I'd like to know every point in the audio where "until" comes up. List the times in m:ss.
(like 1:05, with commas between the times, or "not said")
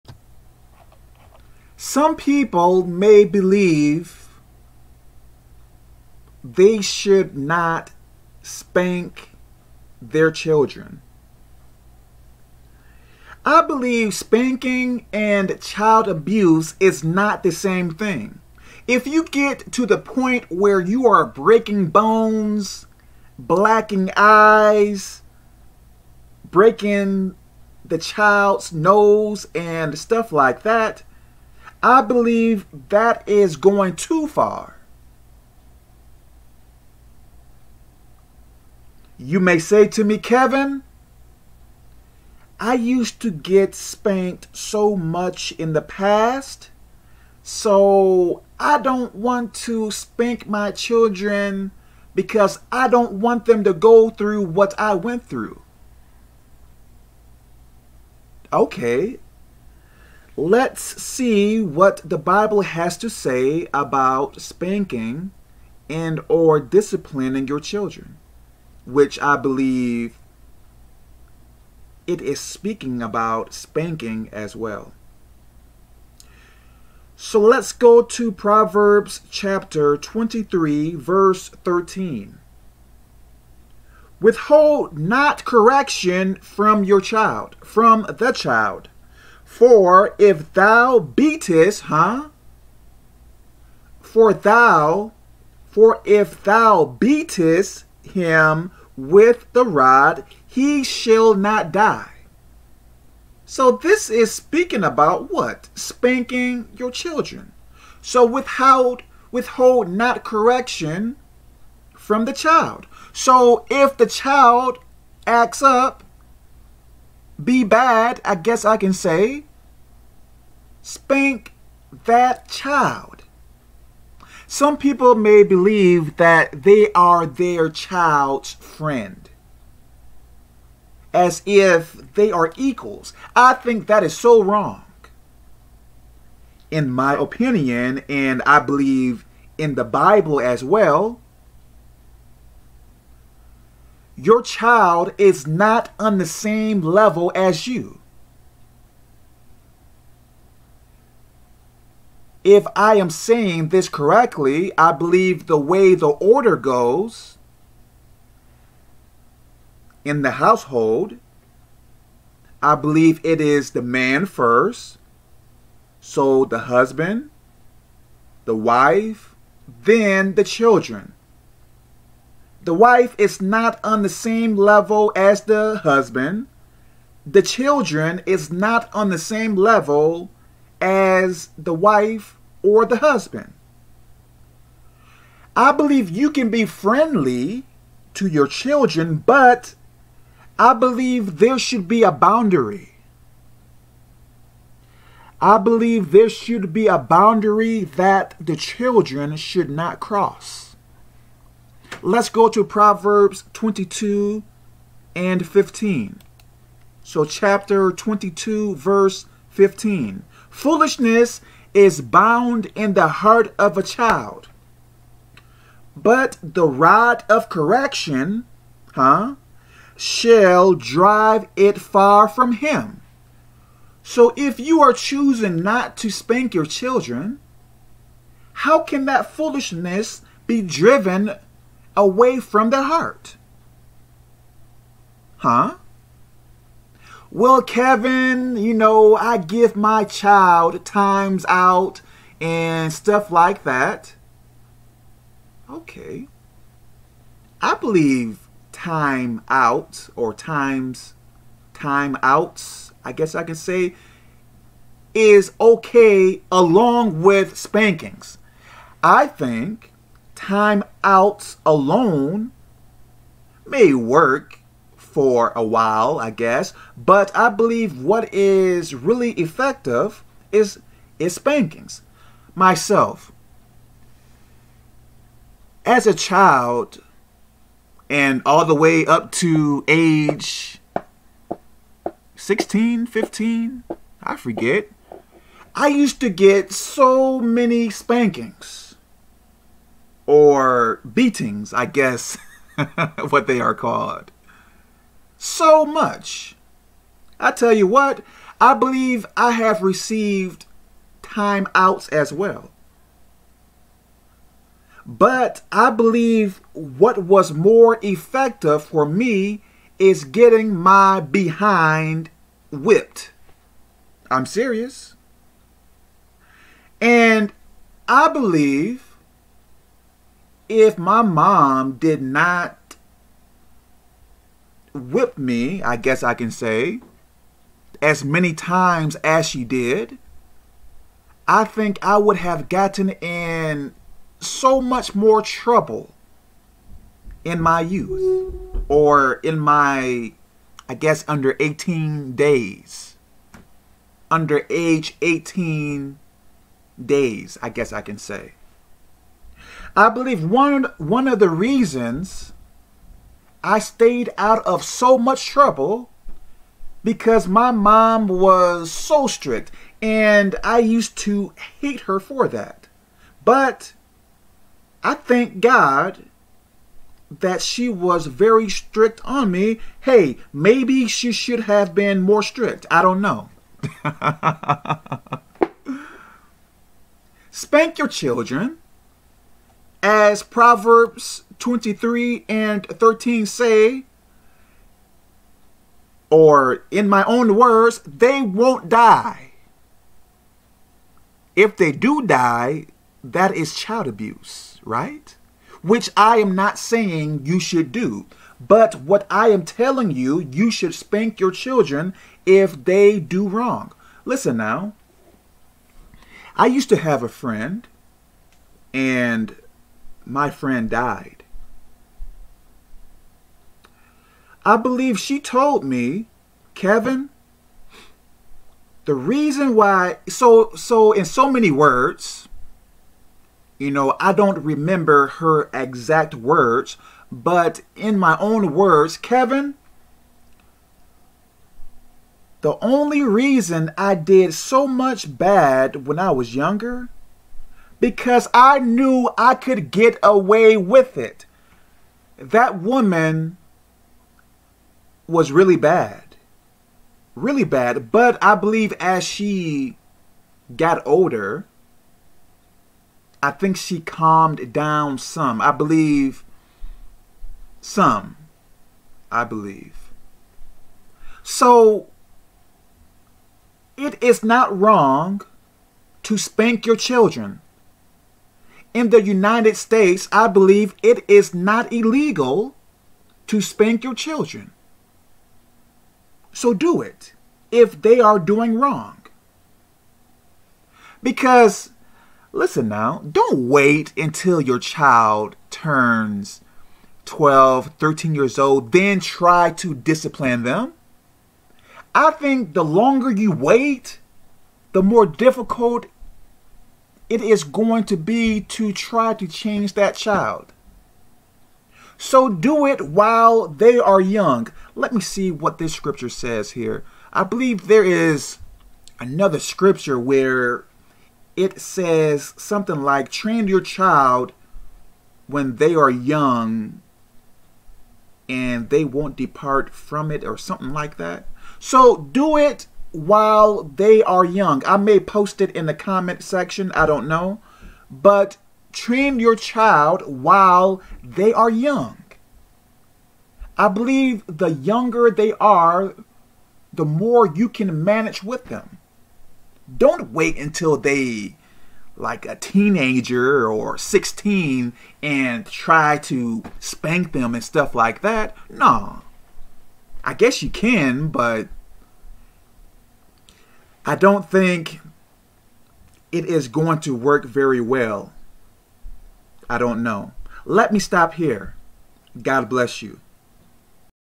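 8:04, 9:00.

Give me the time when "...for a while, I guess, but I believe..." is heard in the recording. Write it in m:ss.
4:24.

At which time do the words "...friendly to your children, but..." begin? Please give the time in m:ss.
3:06.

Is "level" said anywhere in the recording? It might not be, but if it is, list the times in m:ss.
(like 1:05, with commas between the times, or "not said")
2:26, 2:54, 2:59.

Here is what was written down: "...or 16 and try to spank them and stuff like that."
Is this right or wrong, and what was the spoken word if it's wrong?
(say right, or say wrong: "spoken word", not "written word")
right.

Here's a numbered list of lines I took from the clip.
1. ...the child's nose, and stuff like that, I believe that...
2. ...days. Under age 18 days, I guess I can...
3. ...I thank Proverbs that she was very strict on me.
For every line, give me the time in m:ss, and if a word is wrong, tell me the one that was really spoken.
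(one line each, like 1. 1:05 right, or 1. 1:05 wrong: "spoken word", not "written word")
1. 0:27 right
2. 5:42 right
3. 6:05 wrong: "God", not "Proverbs".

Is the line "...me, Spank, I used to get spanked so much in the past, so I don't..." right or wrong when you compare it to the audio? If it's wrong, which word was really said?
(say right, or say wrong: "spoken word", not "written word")
wrong: "Kevin", not "Spank".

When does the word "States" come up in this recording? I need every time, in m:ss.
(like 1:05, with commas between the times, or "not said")
7:49.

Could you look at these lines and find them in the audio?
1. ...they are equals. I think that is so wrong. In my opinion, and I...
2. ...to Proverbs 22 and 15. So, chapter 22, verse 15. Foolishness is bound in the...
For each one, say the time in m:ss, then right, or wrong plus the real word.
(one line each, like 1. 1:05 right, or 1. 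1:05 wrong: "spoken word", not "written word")
1. 2:12 right
2. 3:22 right.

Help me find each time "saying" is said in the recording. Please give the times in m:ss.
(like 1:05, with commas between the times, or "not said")
2:33, 6:36.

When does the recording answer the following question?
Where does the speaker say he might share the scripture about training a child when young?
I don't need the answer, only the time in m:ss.
8:45.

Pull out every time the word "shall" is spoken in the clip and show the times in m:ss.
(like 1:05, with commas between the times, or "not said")
1:40, 3:39.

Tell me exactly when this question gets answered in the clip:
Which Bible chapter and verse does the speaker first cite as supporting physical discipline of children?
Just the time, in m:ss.
1:18.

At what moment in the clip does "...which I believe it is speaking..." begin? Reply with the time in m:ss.
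1:08.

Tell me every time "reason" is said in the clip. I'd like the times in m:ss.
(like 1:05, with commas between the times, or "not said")
5:51, 6:59, 7:13.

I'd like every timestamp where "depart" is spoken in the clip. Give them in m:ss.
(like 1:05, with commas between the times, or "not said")
8:39.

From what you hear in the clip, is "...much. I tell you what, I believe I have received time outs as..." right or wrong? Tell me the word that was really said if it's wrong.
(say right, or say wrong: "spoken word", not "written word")
right.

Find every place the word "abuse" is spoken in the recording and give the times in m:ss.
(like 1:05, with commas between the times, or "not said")
0:16, 6:34.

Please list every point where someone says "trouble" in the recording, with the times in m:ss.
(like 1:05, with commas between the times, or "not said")
5:35, 5:55.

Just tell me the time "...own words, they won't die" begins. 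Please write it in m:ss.
6:27.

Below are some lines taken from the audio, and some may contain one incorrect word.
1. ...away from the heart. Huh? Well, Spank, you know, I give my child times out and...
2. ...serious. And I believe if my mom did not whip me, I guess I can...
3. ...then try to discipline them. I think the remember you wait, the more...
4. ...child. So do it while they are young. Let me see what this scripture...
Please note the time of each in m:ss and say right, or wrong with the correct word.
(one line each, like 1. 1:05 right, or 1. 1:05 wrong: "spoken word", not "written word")
1. 3:51 wrong: "Kevin", not "Spank"
2. 5:14 right
3. 8:08 wrong: "longer", not "remember"
4. 8:20 right.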